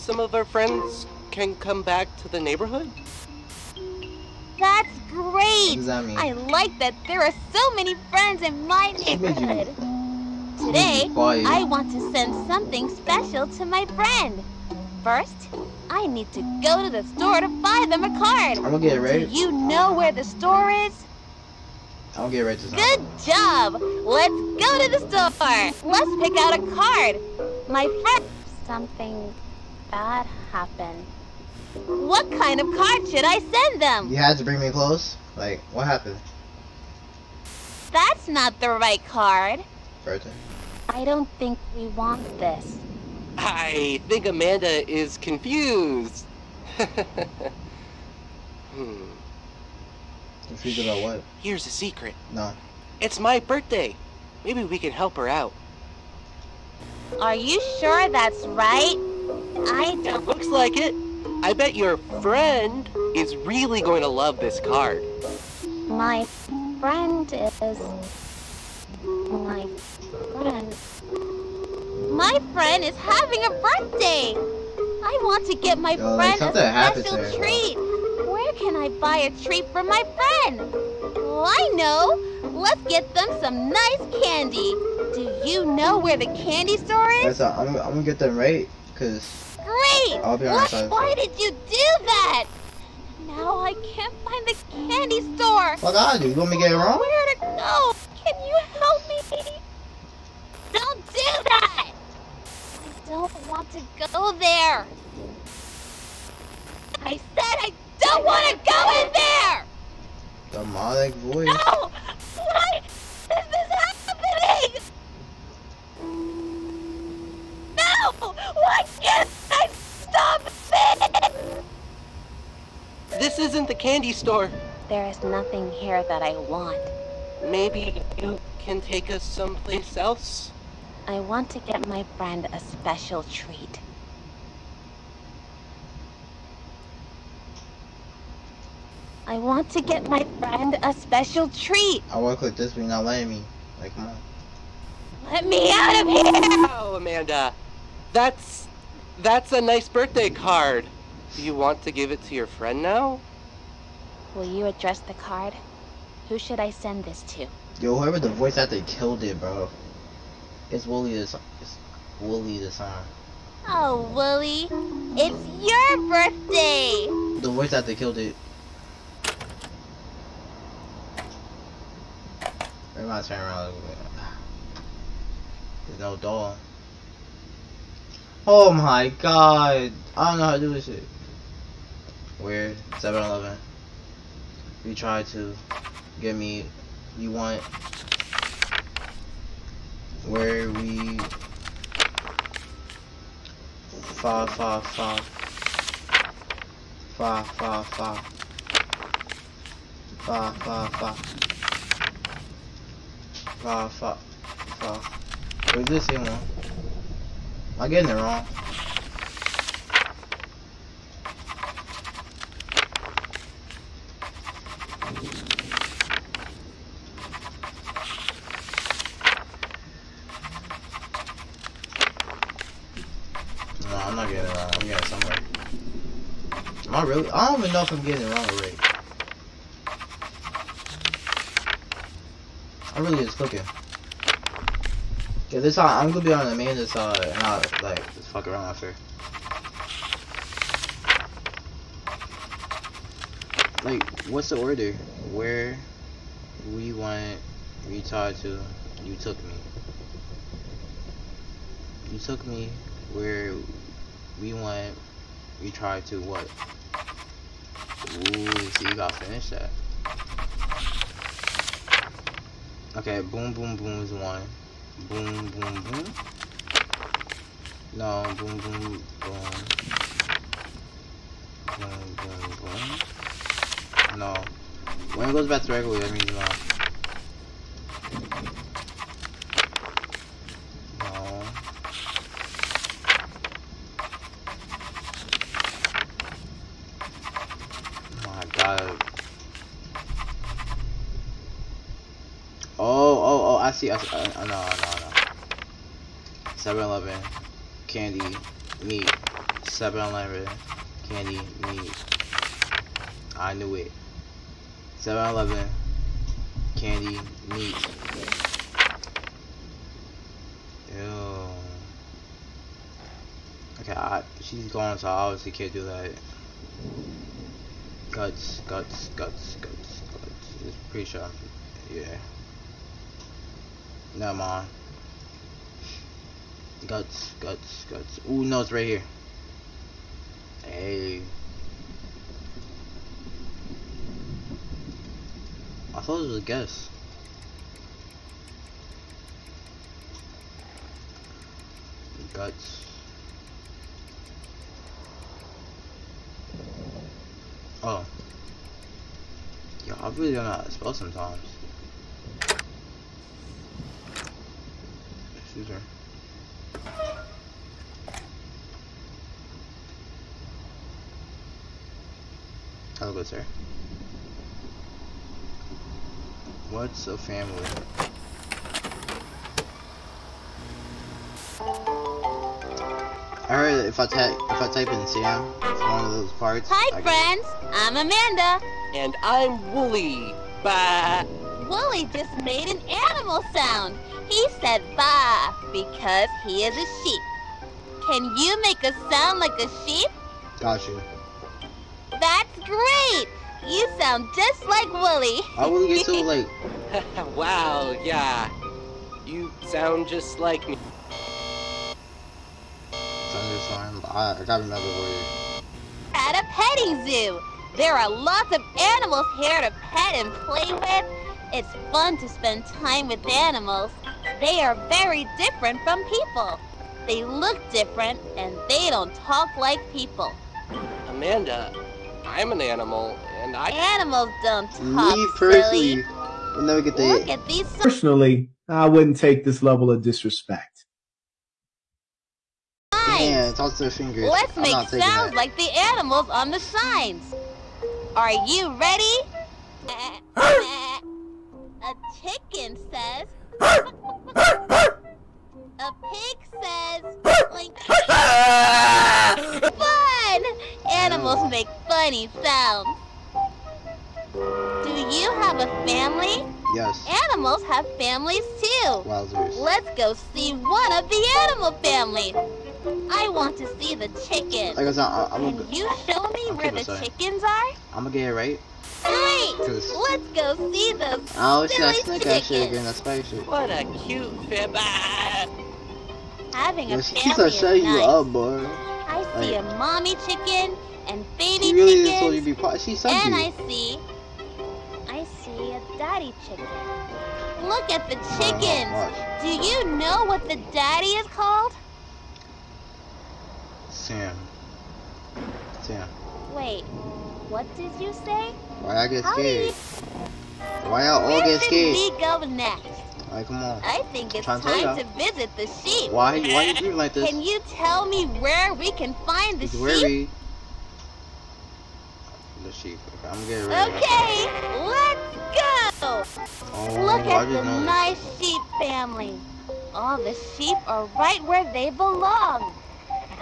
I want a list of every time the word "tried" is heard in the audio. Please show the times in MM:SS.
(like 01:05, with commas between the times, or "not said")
04:15.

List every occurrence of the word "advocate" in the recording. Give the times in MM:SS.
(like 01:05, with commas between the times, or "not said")
not said.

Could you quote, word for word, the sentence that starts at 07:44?
Like I said, I, I'm Can you show me where the sorry.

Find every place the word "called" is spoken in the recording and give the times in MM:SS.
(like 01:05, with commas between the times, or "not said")
08:11.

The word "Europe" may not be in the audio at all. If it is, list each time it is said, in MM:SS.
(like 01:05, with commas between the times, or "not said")
not said.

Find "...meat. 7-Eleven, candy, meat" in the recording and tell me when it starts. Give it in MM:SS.
04:58.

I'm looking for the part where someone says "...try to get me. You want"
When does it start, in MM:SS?
03:04.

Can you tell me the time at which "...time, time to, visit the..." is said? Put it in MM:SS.
08:24.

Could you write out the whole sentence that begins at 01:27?
I'm, I'm gonna get them right, because great!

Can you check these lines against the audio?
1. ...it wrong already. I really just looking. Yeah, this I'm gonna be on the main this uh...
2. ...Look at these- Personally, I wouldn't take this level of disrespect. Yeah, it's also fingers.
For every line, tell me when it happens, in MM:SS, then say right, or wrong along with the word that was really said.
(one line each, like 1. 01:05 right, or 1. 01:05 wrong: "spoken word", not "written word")
1. 03:48 right
2. 07:07 right.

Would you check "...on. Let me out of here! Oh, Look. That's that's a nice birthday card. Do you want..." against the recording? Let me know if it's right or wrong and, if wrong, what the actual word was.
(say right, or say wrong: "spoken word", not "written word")
wrong: "Amanda", not "Look".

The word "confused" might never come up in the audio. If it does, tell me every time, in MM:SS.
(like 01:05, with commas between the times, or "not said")
00:45, 00:50.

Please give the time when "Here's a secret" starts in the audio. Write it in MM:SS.
00:51.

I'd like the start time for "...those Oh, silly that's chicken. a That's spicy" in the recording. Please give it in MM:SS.
07:50.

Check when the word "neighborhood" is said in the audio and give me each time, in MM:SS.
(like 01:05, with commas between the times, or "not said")
00:02, 00:09.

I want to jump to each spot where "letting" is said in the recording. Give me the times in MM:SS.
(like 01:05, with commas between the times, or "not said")
02:23.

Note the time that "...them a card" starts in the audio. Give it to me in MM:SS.
00:17.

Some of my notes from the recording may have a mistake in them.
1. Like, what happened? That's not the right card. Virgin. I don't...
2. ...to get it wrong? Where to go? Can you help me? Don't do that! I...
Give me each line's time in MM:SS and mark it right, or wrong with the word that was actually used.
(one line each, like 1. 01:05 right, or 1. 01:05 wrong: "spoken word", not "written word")
1. 00:35 right
2. 01:36 right.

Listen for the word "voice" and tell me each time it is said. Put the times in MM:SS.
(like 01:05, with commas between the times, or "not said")
01:51, 02:38, 02:47.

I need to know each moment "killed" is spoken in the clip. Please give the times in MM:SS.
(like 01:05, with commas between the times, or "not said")
02:38, 02:47.